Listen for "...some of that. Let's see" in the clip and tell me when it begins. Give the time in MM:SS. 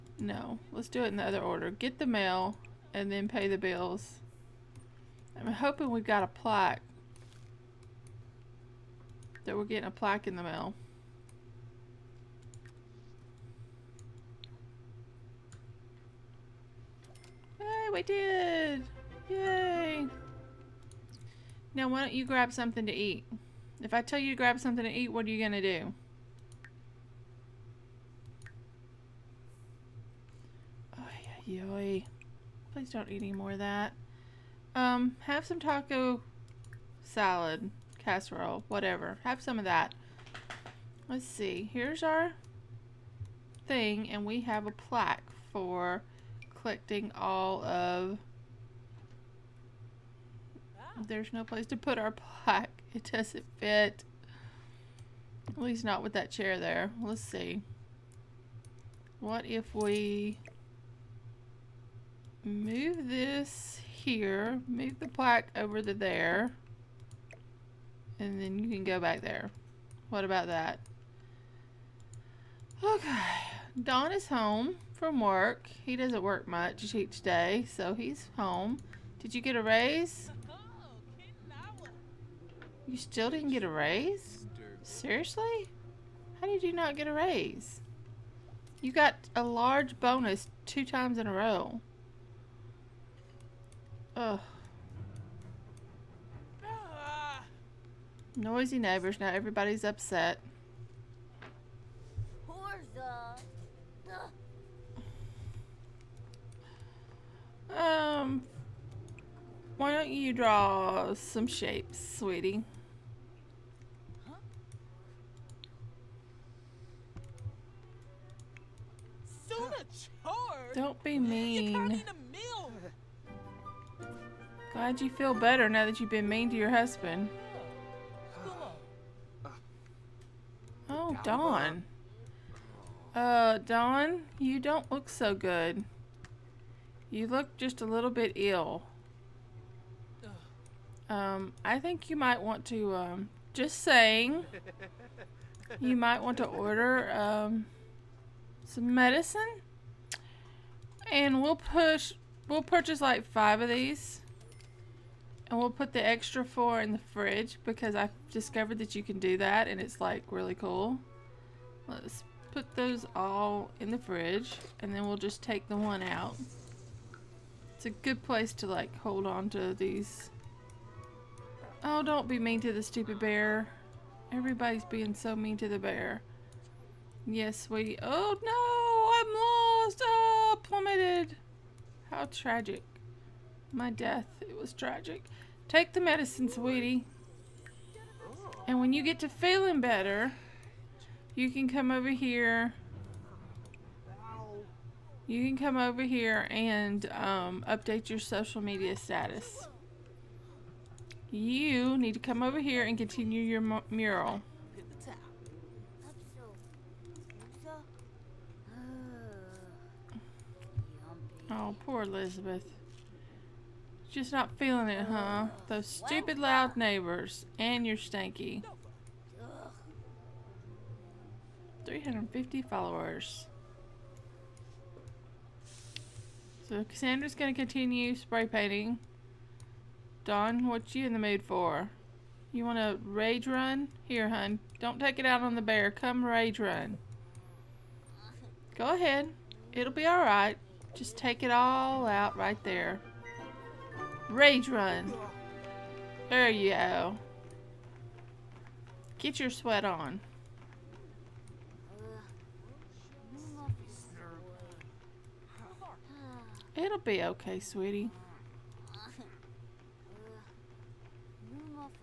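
00:39.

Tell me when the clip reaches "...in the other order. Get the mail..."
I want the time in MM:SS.
00:01.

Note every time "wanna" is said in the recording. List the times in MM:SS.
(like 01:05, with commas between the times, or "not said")
03:52.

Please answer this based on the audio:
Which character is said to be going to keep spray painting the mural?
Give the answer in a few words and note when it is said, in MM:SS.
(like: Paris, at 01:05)
Cassandra, at 03:46.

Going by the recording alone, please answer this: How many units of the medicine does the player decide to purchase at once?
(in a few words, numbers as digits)
5.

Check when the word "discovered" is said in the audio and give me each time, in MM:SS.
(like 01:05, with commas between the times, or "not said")
02:38.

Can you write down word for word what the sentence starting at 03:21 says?
You need to come over here and continue your mural.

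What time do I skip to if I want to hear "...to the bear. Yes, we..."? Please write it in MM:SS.
02:55.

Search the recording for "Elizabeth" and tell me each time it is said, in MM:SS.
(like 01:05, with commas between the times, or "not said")
03:32.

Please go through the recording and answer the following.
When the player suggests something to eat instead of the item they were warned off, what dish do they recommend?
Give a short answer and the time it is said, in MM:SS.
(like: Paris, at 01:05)
Taco salad casserole, at 00:35.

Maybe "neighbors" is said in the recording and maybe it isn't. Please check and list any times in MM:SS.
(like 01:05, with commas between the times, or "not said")
01:38, 03:36.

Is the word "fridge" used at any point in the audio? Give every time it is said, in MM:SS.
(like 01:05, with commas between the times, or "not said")
02:37, 02:43.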